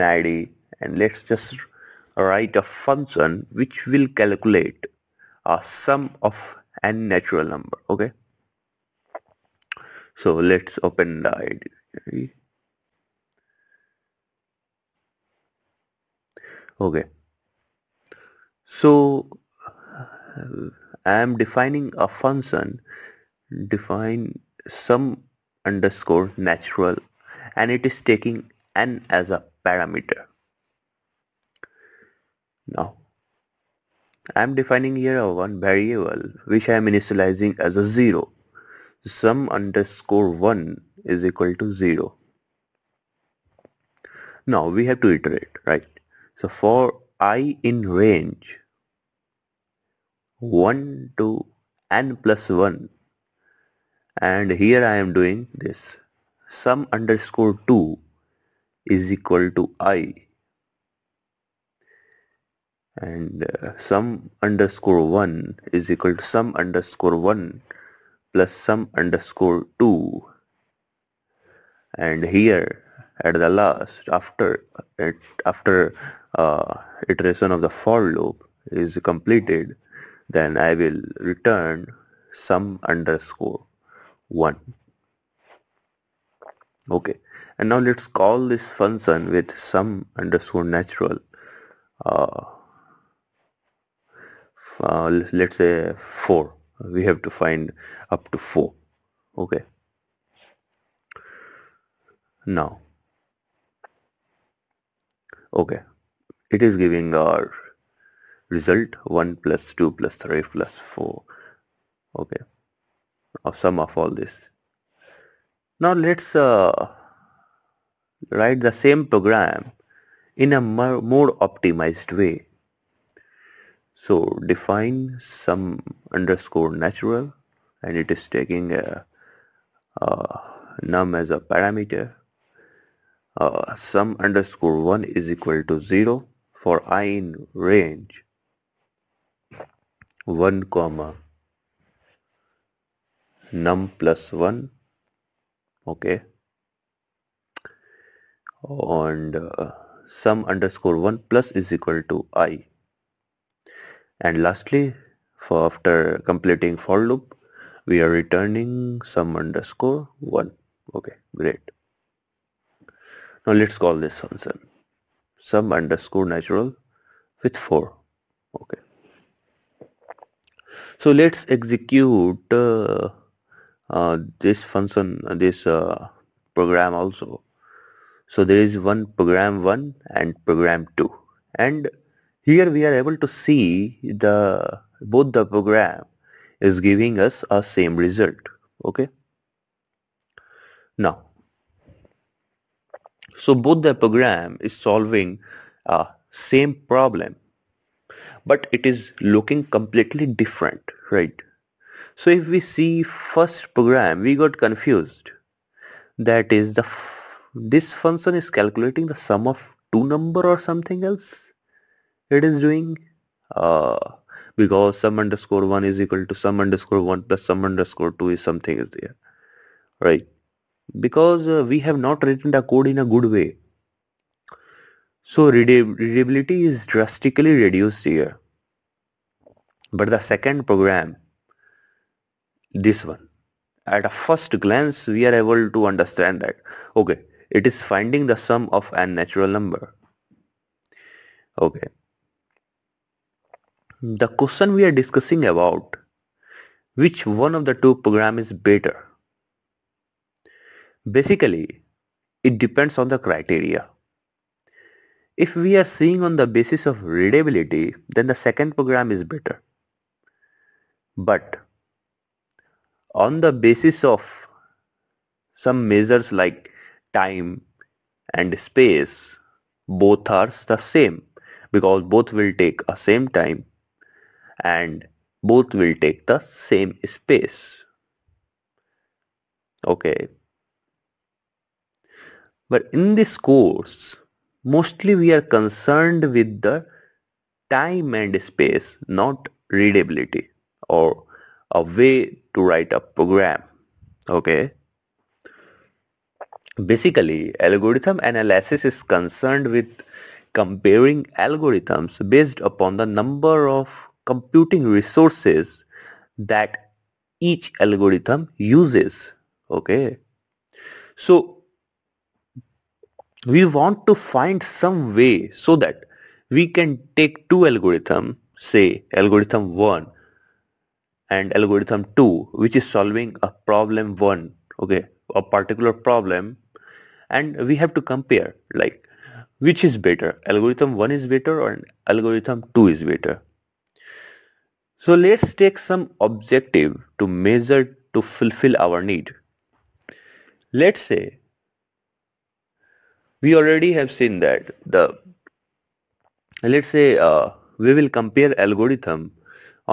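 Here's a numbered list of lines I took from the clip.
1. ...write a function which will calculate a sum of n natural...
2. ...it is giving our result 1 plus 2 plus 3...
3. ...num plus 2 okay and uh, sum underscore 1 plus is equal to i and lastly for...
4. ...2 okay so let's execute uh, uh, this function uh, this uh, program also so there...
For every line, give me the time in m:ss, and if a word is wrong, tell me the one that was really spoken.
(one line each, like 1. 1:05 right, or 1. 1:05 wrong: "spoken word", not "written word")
1. 0:02 right
2. 1:46 right
3. 2:23 wrong: "1", not "2"
4. 2:47 wrong: "4", not "2".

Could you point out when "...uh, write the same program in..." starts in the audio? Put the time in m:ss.
1:56.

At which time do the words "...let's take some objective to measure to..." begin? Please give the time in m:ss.
5:35.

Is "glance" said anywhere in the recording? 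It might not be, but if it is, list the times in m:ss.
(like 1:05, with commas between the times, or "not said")
3:54.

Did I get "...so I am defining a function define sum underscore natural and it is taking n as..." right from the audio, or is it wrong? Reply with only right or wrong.
right.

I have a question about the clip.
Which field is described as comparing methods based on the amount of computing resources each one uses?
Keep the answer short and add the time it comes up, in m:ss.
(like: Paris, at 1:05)
algorithm analysis, at 4:57.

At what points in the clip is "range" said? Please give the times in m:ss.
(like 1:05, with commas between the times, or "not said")
0:47, 2:17.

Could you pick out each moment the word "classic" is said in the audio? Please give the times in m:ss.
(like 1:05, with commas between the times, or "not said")
not said.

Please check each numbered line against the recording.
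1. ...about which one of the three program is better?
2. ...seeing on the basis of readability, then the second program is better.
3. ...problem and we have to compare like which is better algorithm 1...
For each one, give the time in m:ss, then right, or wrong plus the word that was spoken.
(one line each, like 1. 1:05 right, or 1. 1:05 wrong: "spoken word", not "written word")
1. 4:05 wrong: "two", not "three"
2. 4:15 right
3. 5:25 right.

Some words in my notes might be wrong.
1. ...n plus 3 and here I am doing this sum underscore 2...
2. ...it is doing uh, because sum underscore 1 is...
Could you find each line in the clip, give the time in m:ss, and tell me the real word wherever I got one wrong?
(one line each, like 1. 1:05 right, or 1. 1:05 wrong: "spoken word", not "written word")
1. 0:51 wrong: "1", not "3"
2. 3:32 right.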